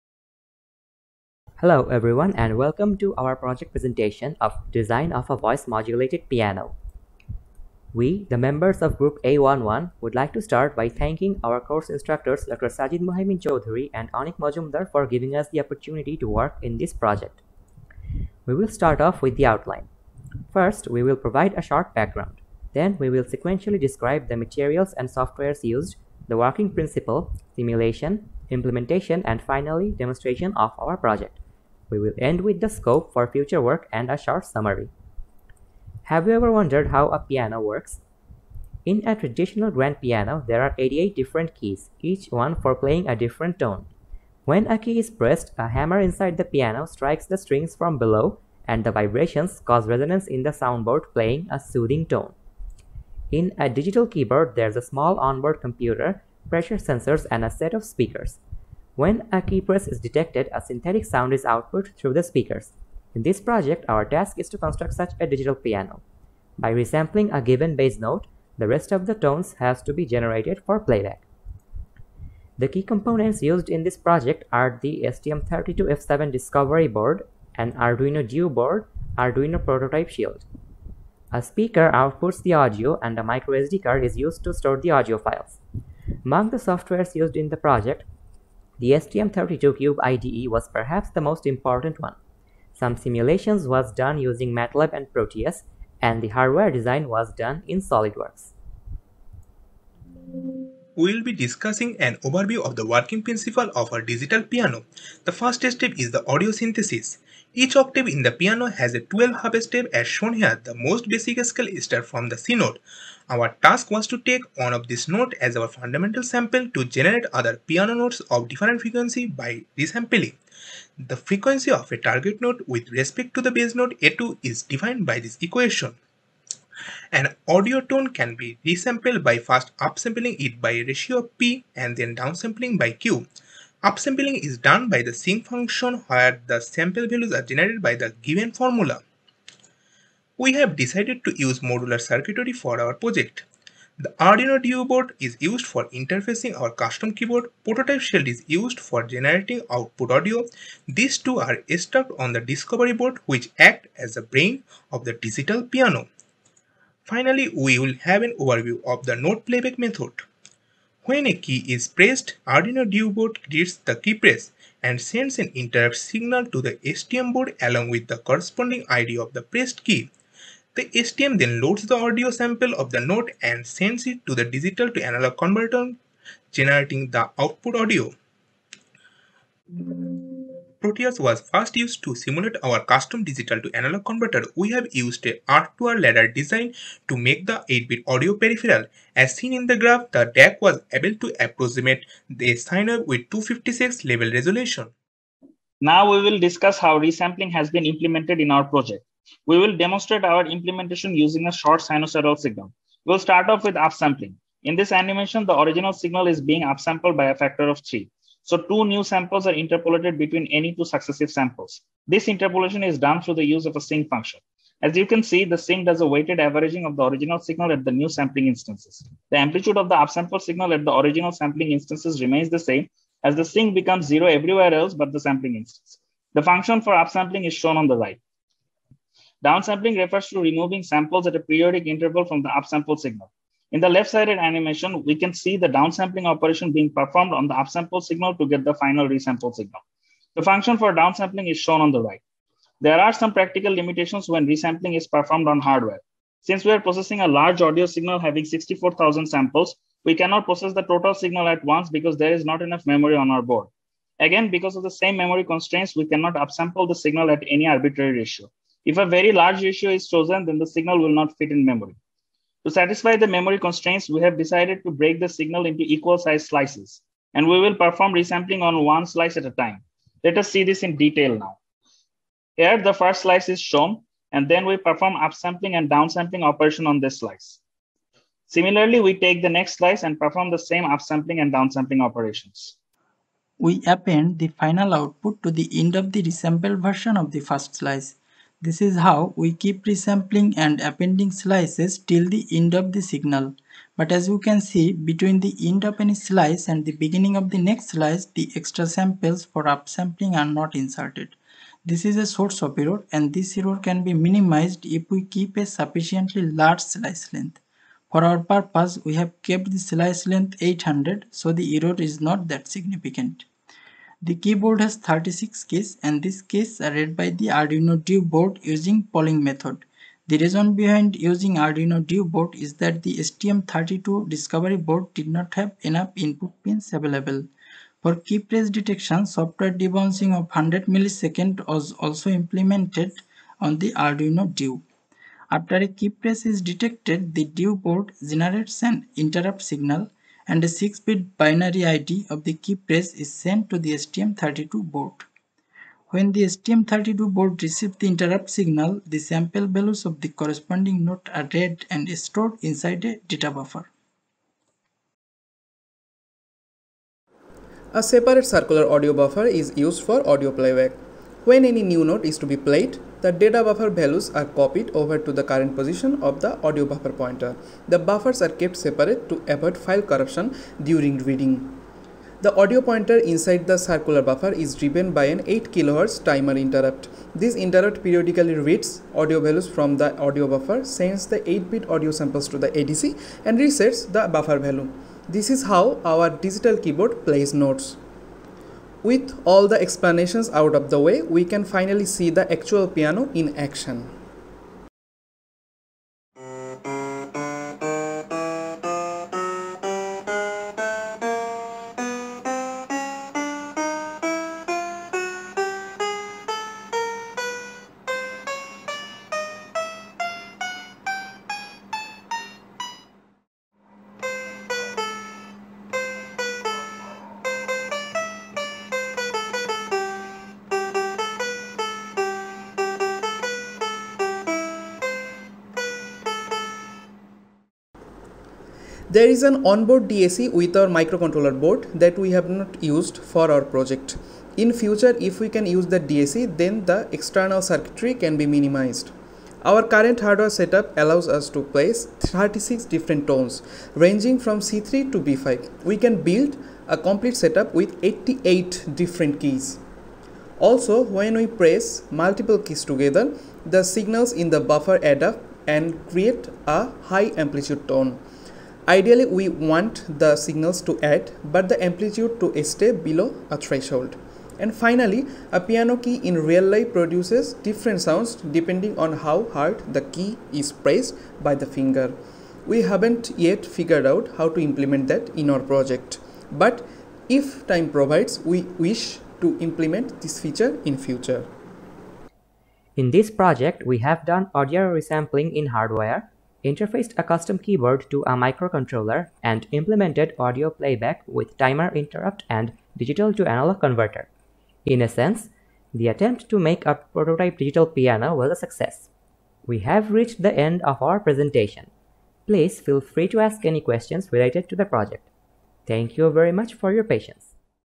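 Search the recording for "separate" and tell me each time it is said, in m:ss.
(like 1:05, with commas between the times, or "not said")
5:58, 6:08.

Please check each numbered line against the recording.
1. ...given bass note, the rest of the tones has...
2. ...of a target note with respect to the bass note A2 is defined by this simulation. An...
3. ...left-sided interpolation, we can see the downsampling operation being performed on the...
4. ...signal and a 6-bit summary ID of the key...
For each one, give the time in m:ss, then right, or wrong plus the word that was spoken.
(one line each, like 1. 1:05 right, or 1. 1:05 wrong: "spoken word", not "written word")
1. 1:07 right
2. 2:01 wrong: "equation", not "simulation"
3. 3:53 wrong: "animation", not "interpolation"
4. 5:39 wrong: "binary", not "summary".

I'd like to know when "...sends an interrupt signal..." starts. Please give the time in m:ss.
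2:45.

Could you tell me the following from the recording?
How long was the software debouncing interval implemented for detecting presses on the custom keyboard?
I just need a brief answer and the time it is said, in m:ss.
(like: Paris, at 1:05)
100 milliseconds, at 5:30.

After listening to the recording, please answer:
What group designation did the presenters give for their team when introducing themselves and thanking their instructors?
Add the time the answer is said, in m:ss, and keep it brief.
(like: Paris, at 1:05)
A11, at 0:08.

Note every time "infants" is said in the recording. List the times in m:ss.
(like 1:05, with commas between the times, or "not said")
not said.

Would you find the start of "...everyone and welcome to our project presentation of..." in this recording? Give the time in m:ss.
0:01.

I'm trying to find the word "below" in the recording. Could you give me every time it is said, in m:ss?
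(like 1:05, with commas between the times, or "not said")
0:47, 7:42.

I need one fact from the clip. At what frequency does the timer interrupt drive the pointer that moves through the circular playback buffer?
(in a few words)
8 kHz.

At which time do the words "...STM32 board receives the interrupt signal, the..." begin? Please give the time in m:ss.
5:46.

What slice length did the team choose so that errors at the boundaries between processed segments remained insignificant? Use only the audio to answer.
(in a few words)
800.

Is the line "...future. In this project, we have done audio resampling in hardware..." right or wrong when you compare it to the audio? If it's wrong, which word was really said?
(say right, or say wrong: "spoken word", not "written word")
right.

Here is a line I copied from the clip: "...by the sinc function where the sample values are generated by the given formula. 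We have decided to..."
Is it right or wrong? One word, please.
right.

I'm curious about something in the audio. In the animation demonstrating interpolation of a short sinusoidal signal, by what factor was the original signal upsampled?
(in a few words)
3.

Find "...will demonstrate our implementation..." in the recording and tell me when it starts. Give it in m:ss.
3:19.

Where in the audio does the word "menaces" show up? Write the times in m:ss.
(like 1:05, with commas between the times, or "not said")
not said.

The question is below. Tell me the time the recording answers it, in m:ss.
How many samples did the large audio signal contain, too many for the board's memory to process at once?
4:08.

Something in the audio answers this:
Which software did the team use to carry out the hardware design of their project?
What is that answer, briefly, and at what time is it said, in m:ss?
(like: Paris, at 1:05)
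SolidWorks, at 1:37.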